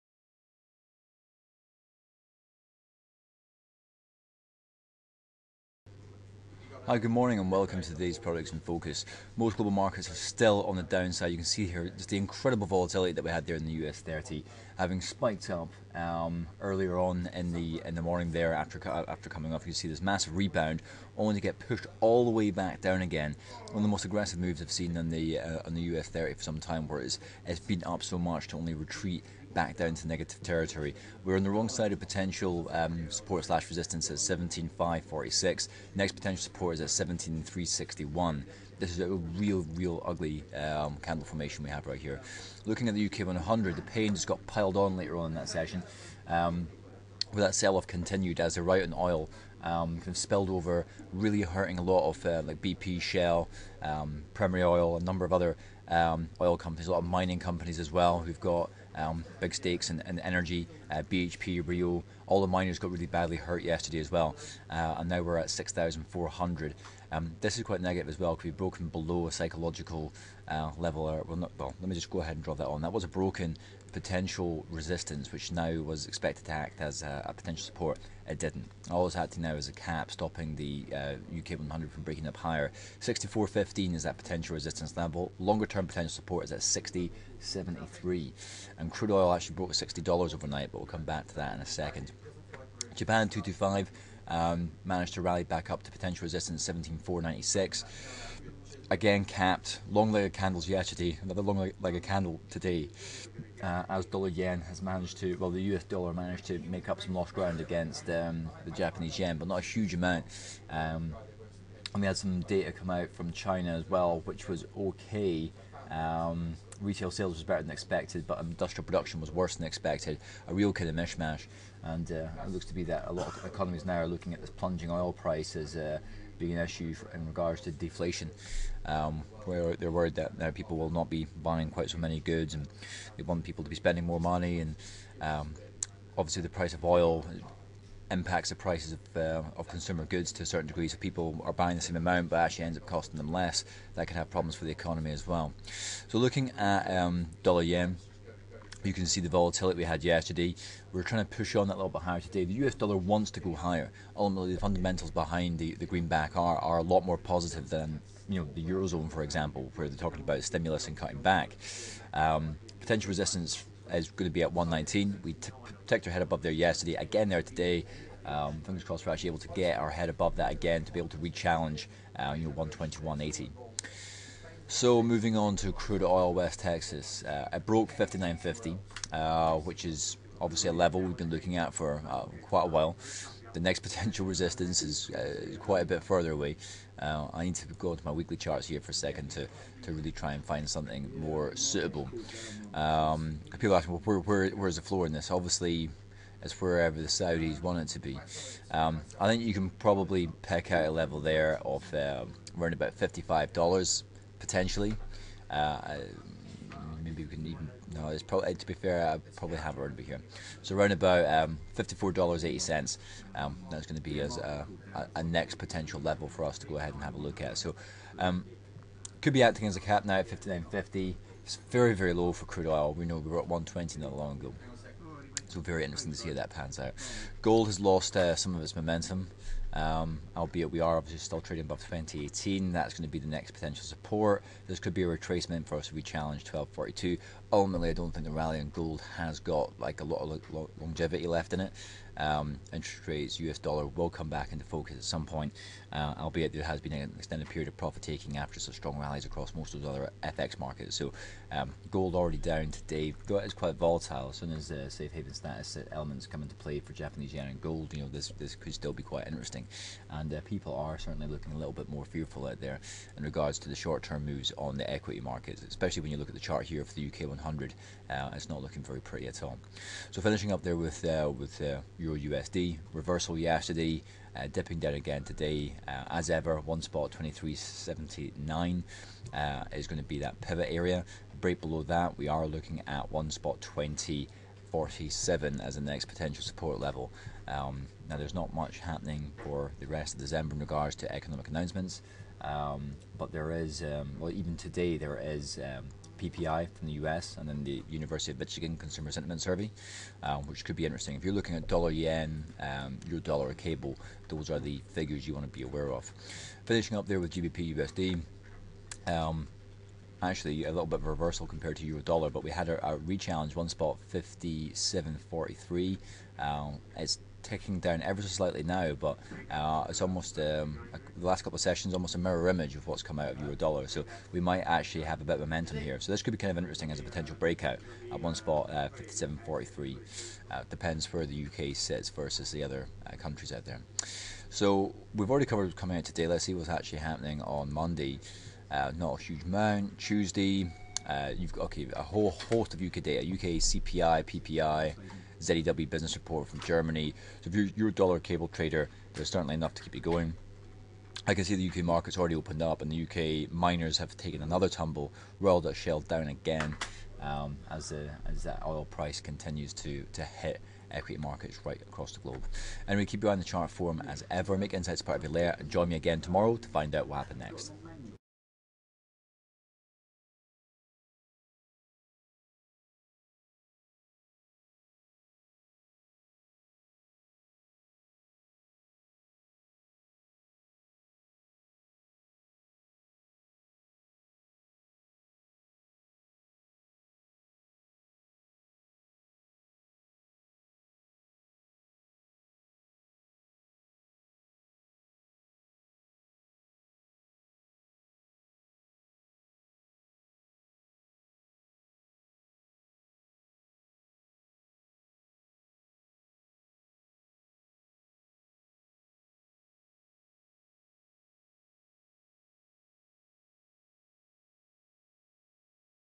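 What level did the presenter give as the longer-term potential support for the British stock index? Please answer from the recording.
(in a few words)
60.73.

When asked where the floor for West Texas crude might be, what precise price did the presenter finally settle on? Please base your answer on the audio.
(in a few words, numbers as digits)
$54.80.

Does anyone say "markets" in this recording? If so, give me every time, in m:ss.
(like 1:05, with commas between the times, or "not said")
0:09, 4:10, 4:25, 5:51, 6:01.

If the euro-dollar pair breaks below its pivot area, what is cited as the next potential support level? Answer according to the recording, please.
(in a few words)
1.2047.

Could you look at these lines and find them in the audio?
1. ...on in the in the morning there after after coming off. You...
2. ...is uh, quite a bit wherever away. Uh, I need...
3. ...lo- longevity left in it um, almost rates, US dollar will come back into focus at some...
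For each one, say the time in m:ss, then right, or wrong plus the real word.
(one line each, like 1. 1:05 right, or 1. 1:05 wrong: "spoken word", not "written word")
1. 0:16 right
2. 3:04 wrong: "further", not "wherever"
3. 4:00 wrong: "interest", not "almost".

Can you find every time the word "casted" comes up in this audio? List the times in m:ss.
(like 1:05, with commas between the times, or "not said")
not said.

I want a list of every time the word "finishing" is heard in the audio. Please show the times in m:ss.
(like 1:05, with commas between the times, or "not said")
4:30, 5:06.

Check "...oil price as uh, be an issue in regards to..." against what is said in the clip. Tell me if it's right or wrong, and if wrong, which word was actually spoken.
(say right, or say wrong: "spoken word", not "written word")
right.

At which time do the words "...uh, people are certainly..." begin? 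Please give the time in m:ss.
4:20.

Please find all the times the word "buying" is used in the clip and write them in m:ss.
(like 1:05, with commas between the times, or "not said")
2:11, 2:21.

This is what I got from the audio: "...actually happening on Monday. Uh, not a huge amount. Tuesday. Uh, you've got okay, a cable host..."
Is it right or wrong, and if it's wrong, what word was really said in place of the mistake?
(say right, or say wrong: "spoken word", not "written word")
wrong: "whole", not "cable".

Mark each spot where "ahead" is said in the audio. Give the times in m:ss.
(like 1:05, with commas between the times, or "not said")
1:12, 3:36.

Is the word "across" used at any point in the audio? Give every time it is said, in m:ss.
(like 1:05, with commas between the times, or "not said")
4:09, 6:01.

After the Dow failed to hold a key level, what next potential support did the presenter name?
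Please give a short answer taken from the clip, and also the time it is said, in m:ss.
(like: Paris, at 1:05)
17,361, at 0:37.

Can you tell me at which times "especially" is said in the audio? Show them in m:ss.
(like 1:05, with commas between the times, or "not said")
4:25.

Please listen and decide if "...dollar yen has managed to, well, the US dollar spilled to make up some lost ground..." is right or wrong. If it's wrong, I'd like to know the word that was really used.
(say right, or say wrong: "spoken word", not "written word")
wrong: "managed", not "spilled".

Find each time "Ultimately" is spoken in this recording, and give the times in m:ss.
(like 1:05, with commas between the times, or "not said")
2:34, 3:57.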